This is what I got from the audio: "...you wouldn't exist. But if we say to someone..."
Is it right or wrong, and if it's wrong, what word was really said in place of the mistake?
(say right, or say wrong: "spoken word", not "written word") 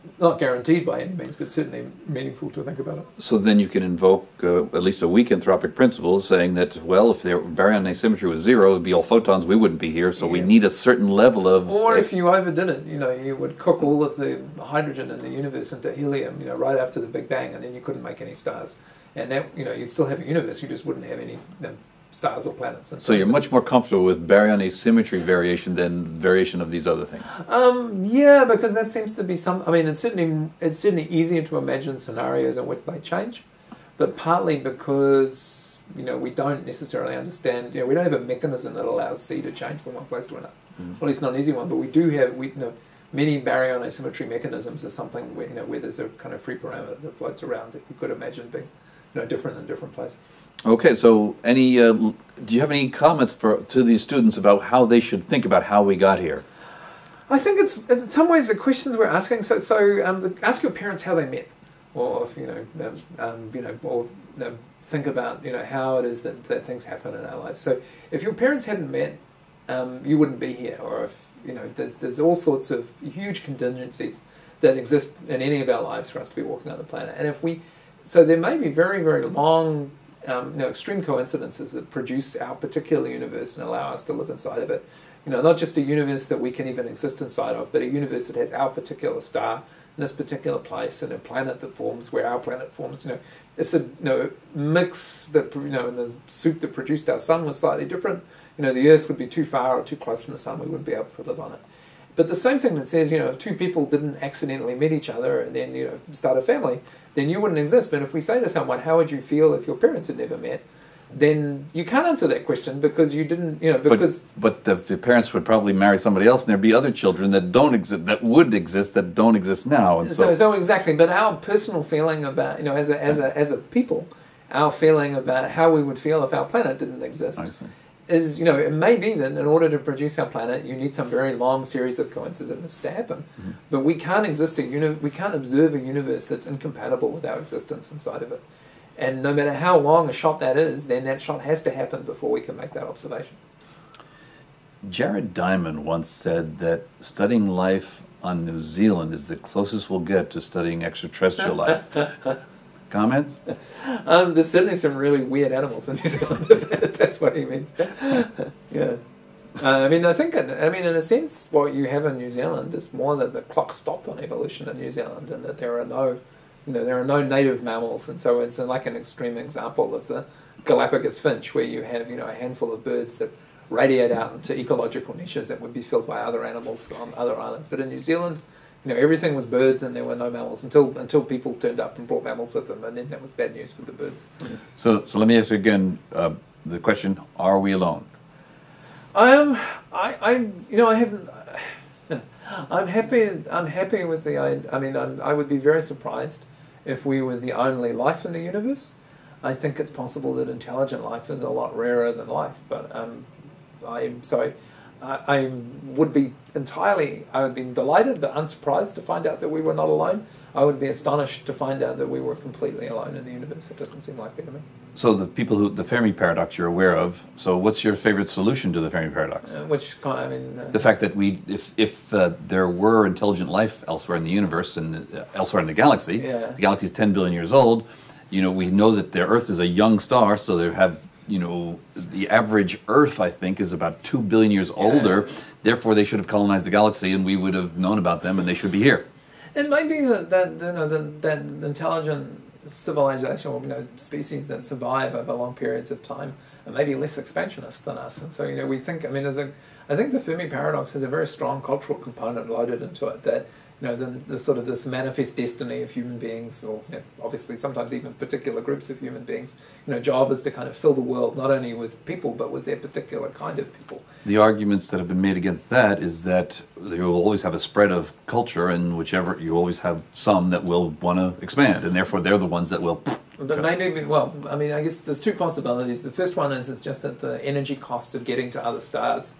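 right.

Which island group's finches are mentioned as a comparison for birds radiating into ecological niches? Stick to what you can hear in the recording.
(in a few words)
Galapagos.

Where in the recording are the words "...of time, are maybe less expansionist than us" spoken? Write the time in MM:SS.
04:05.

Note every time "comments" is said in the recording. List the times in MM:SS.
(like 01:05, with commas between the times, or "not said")
00:52, 02:32.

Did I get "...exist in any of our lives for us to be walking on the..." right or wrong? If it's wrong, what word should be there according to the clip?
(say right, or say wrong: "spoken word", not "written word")
right.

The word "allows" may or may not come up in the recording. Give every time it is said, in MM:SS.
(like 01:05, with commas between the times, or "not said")
00:38, 01:23.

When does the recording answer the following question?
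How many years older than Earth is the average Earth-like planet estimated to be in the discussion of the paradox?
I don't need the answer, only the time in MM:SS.
03:54.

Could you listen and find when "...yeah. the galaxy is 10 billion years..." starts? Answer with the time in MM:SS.
03:46.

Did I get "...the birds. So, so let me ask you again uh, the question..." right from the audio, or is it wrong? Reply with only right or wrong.
right.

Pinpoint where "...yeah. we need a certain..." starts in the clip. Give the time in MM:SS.
00:10.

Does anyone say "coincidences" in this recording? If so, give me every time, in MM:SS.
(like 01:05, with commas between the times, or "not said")
01:21, 02:12.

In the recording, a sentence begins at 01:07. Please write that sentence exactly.
So, if your parents hadn't met, um, you wouldn't be here.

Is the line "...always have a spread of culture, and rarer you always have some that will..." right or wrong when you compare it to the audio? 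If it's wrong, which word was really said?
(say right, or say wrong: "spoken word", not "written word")
wrong: "whichever", not "rarer".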